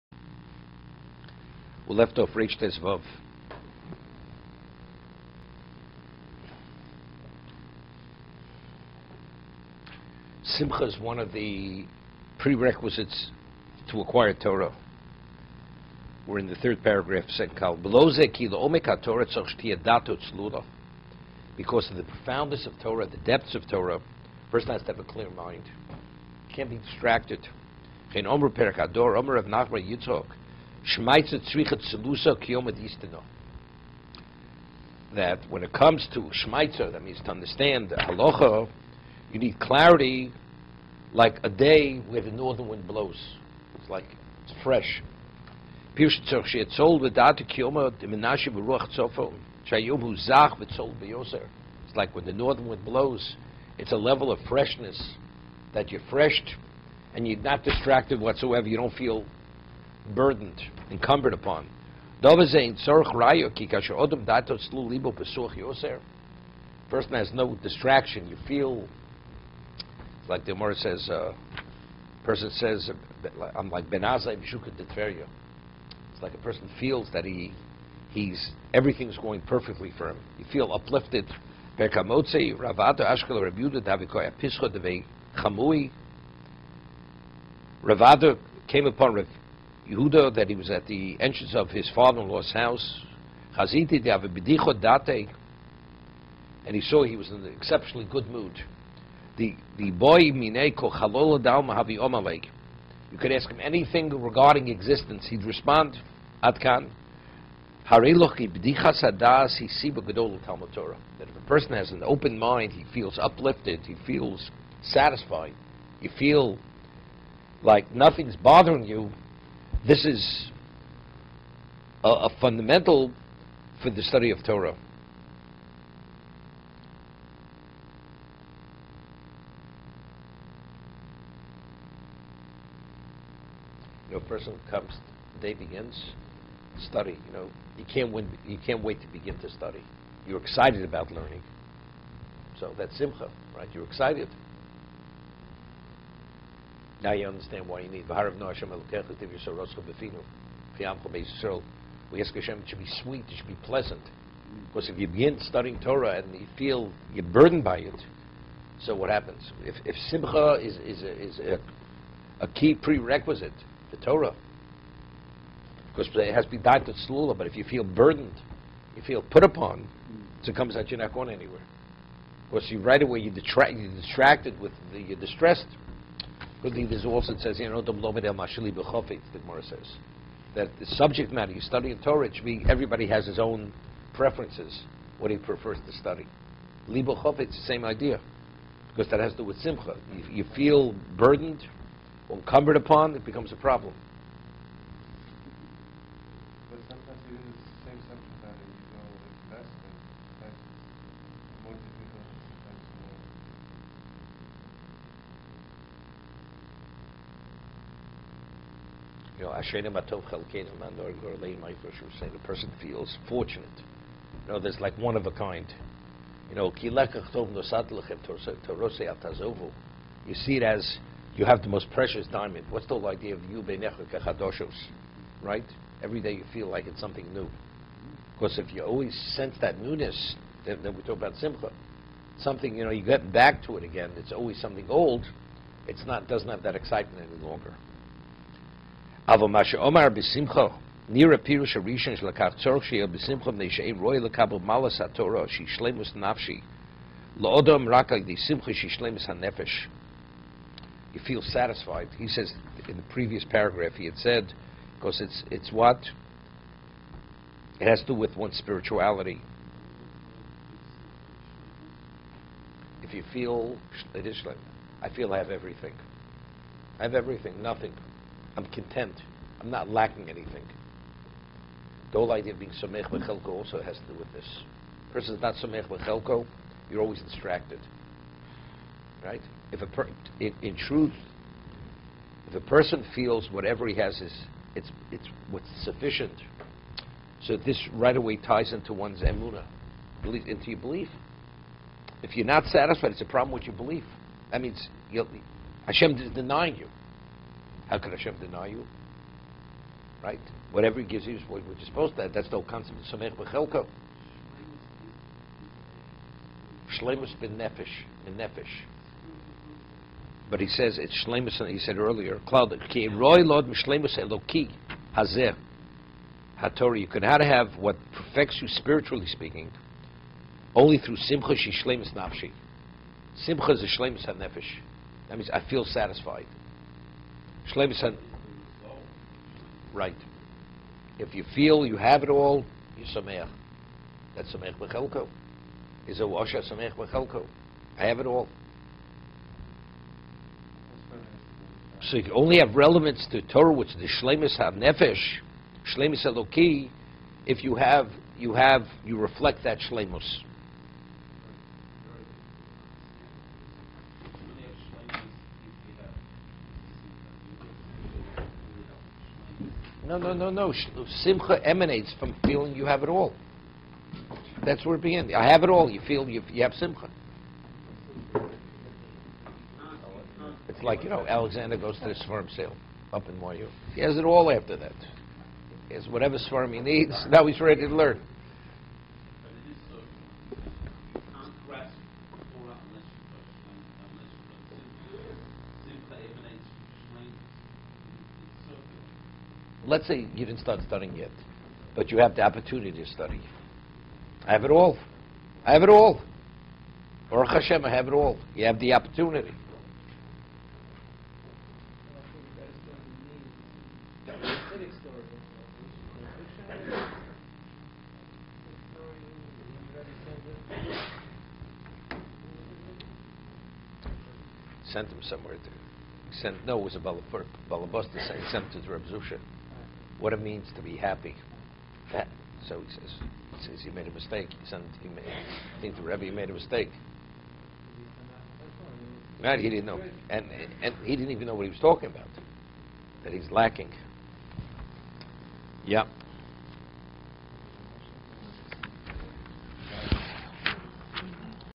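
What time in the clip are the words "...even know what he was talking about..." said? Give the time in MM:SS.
07:11.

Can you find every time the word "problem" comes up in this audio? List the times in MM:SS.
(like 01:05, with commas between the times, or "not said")
03:13, 04:53.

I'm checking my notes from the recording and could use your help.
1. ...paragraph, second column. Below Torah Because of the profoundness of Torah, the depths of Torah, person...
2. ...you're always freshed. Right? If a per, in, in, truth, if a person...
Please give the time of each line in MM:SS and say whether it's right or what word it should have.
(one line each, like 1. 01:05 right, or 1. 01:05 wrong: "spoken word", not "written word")
1. 00:16 right
2. 04:36 wrong: "distracted", not "freshed".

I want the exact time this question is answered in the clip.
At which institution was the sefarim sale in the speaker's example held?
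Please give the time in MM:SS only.
06:13.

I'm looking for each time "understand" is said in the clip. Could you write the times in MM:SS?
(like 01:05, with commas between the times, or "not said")
00:37, 02:27.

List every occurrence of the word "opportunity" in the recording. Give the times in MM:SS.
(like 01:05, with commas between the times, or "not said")
06:32, 06:38.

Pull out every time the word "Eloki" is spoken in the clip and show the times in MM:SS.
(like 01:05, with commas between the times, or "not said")
05:14, 05:46.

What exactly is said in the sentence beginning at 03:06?
Libo chofit, it's the same idea, because that has to do with simcha.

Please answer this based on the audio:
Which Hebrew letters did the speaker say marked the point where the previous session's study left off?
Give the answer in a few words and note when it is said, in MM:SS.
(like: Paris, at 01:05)
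Reish Tes Vav, at 00:02.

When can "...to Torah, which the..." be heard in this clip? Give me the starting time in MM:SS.
05:43.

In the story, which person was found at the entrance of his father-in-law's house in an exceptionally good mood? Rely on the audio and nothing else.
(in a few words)
Yehuda.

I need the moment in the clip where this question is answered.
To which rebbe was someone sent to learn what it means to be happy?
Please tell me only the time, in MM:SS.
06:58.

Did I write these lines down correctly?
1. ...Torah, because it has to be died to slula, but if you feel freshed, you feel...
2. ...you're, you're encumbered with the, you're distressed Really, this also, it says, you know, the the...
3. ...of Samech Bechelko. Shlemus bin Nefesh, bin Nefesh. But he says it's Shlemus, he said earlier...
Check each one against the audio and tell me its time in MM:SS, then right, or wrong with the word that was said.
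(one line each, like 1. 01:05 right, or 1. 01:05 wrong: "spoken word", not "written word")
1. 02:43 wrong: "burdened", not "freshed"
2. 02:53 wrong: "distracted", not "encumbered"
3. 05:02 right.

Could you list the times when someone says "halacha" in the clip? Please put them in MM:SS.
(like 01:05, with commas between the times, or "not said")
00:37.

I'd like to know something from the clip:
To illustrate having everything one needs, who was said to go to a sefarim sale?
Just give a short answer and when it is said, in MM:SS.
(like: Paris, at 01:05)
Alexander, at 06:11.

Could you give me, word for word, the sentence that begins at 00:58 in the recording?
You don't feel burdened incumbent upon.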